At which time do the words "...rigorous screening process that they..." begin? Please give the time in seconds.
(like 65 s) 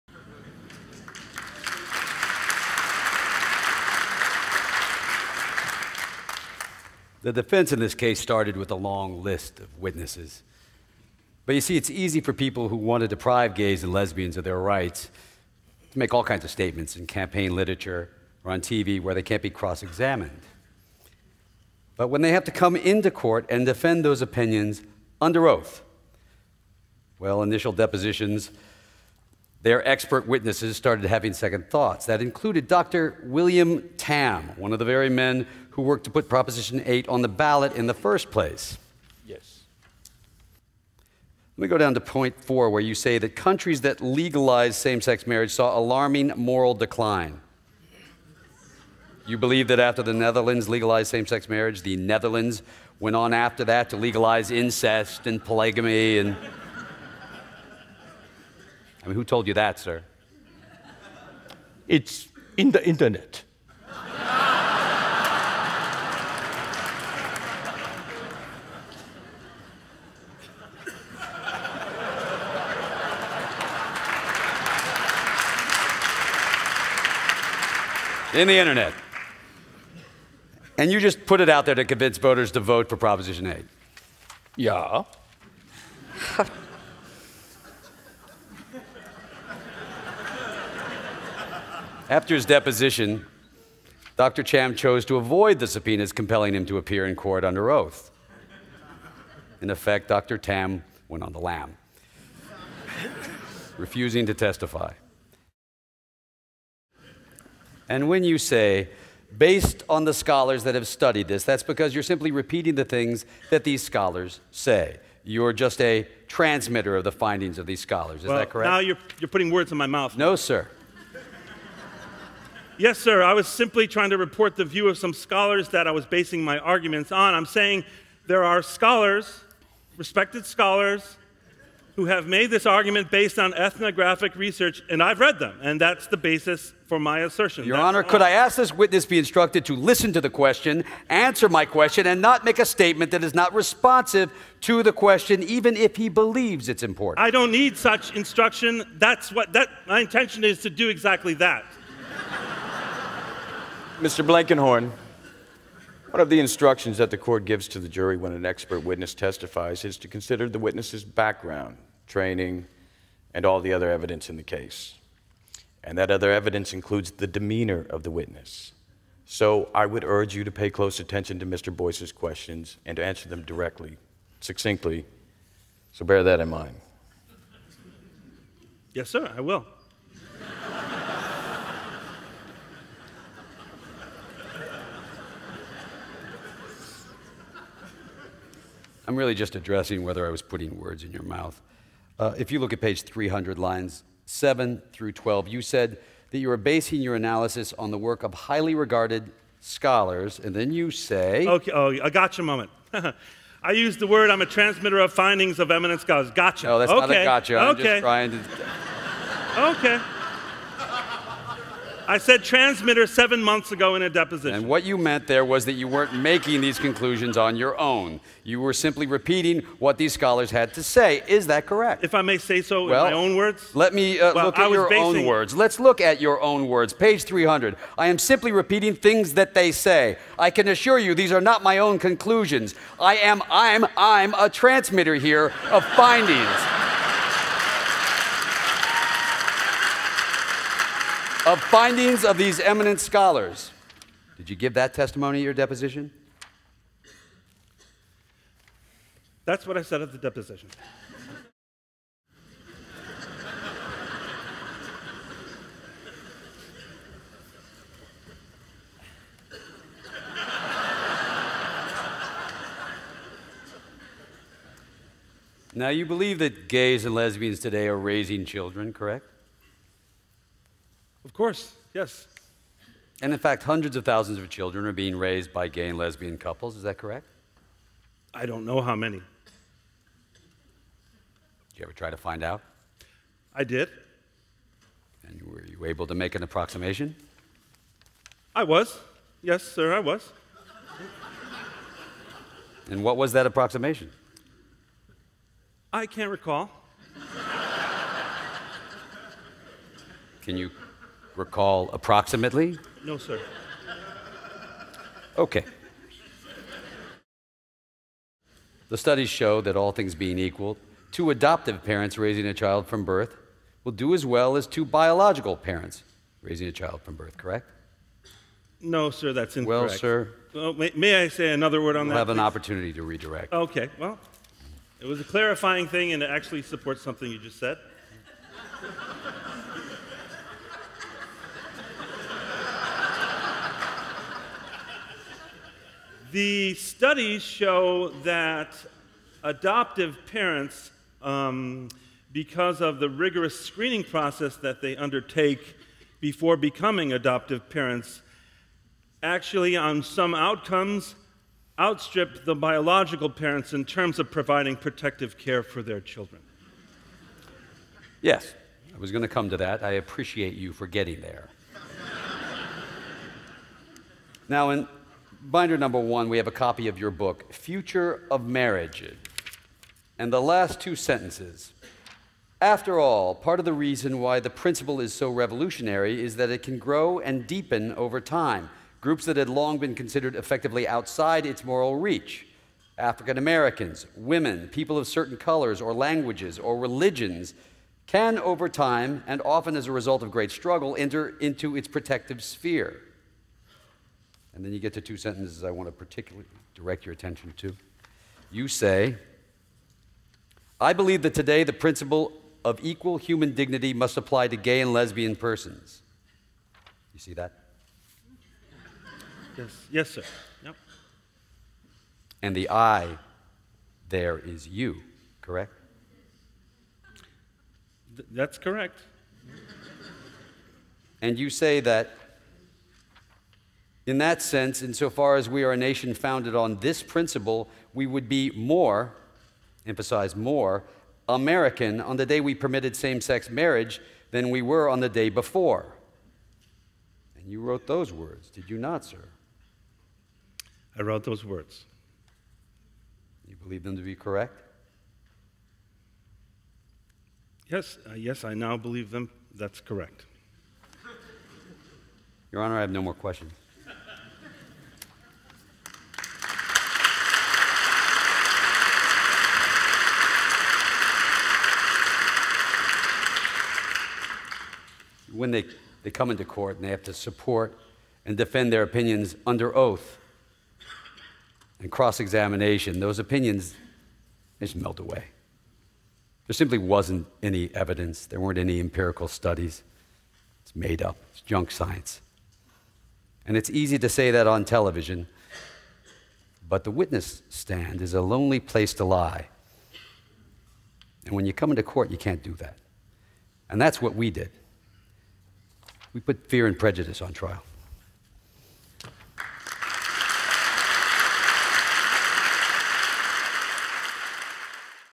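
343 s.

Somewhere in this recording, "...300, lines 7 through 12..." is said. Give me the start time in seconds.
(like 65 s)
193 s.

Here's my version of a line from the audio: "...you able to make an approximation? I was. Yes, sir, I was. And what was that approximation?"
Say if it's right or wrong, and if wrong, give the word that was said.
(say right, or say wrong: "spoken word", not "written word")
right.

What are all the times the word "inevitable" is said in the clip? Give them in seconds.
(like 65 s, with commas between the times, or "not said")
not said.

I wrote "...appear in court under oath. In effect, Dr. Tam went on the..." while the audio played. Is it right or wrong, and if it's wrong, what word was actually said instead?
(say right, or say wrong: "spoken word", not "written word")
right.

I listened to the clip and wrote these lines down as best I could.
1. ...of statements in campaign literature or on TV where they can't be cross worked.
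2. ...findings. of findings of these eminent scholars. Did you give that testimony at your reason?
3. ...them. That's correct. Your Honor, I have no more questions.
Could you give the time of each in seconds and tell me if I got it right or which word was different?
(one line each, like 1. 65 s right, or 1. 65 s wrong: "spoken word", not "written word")
1. 16 s wrong: "examined", not "worked"
2. 235 s wrong: "deposition", not "reason"
3. 449 s right.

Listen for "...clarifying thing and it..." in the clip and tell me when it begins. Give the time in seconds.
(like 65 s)
325 s.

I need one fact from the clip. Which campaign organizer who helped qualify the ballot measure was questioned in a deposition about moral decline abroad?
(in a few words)
Dr. William Tam.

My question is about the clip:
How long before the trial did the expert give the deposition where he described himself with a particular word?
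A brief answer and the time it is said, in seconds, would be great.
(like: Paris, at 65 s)
7 months, at 213 s.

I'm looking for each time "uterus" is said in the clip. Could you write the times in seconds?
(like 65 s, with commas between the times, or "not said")
not said.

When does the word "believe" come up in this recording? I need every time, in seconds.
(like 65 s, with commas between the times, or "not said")
49 s, 146 s, 266 s, 400 s, 443 s, 448 s.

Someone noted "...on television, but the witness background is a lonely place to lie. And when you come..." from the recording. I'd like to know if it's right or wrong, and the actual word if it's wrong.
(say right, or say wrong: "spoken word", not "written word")
wrong: "stand", not "background".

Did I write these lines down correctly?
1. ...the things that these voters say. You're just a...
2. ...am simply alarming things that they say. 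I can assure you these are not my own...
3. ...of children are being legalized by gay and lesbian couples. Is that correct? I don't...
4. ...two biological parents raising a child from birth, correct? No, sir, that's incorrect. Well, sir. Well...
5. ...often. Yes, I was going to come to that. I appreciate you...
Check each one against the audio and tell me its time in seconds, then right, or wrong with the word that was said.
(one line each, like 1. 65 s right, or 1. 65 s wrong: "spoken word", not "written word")
1. 112 s wrong: "scholars", not "voters"
2. 228 s wrong: "repeating", not "alarming"
3. 274 s wrong: "raised", not "legalized"
4. 314 s right
5. 355 s wrong: "children", not "often".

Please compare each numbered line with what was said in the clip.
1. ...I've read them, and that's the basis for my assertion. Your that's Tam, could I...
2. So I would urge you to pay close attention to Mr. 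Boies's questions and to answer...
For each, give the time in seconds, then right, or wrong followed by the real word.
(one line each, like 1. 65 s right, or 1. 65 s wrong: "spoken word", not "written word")
1. 135 s wrong: "Honor", not "Tam"
2. 169 s right.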